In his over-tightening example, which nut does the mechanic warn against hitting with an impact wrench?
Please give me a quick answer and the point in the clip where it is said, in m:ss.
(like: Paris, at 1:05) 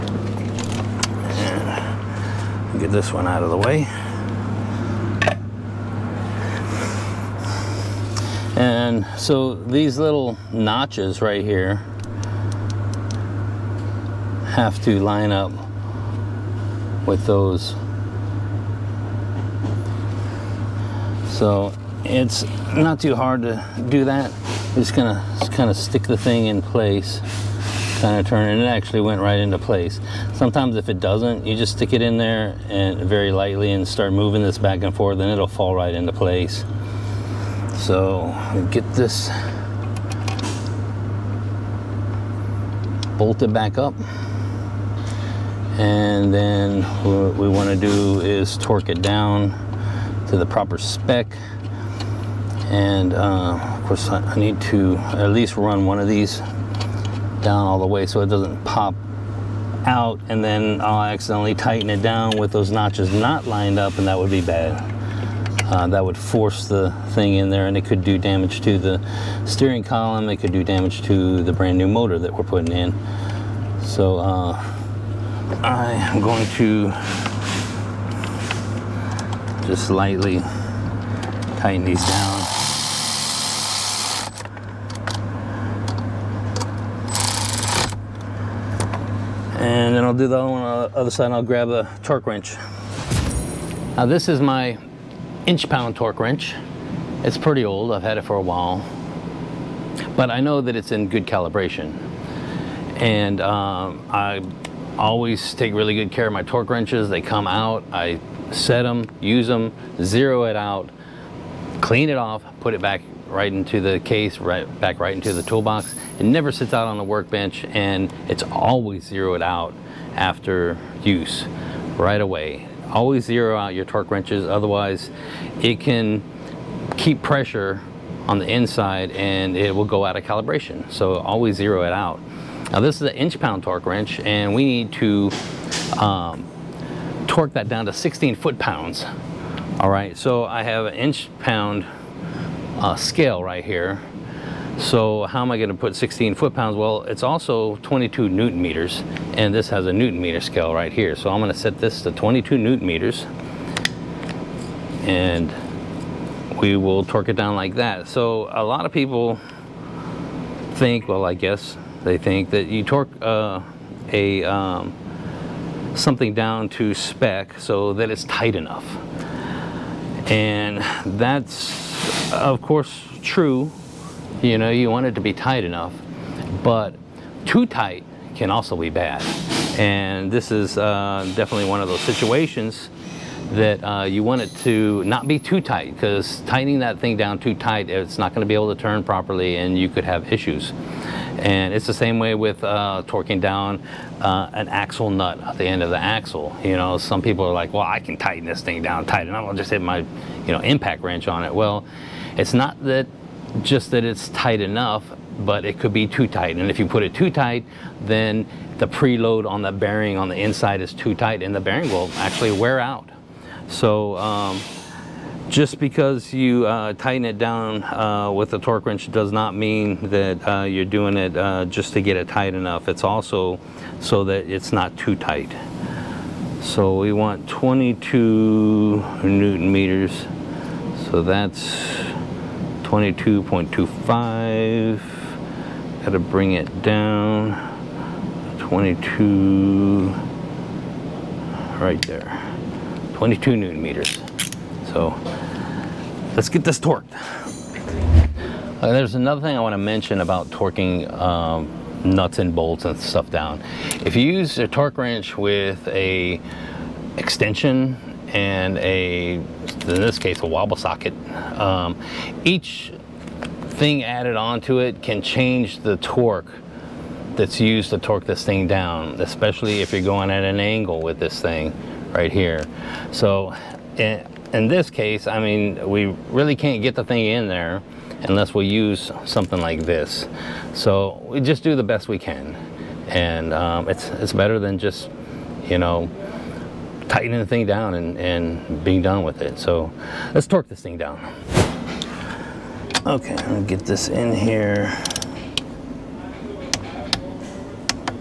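axle nut, at 3:14.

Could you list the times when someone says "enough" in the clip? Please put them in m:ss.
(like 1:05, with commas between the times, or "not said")
2:48, 2:55, 3:24, 3:42.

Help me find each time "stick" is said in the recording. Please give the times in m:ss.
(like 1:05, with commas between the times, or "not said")
0:25, 0:31.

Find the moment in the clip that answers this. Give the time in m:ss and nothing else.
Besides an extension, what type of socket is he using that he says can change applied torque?
4:20.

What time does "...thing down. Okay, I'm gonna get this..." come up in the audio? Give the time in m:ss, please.
4:50.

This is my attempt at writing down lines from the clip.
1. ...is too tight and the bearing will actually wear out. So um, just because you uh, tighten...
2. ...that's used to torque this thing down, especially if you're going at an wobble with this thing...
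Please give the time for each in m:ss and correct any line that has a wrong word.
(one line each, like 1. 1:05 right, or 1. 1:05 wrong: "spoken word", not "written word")
1. 3:30 right
2. 4:27 wrong: "angle", not "wobble".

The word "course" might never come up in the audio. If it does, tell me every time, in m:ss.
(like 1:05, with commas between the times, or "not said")
0:53, 2:52.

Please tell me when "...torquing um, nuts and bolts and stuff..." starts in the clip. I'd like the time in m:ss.
4:10.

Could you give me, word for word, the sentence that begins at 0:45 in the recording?
And then what we want to do is torque it down to the proper spec.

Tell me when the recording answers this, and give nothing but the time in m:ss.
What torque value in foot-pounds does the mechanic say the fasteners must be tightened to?
2:17.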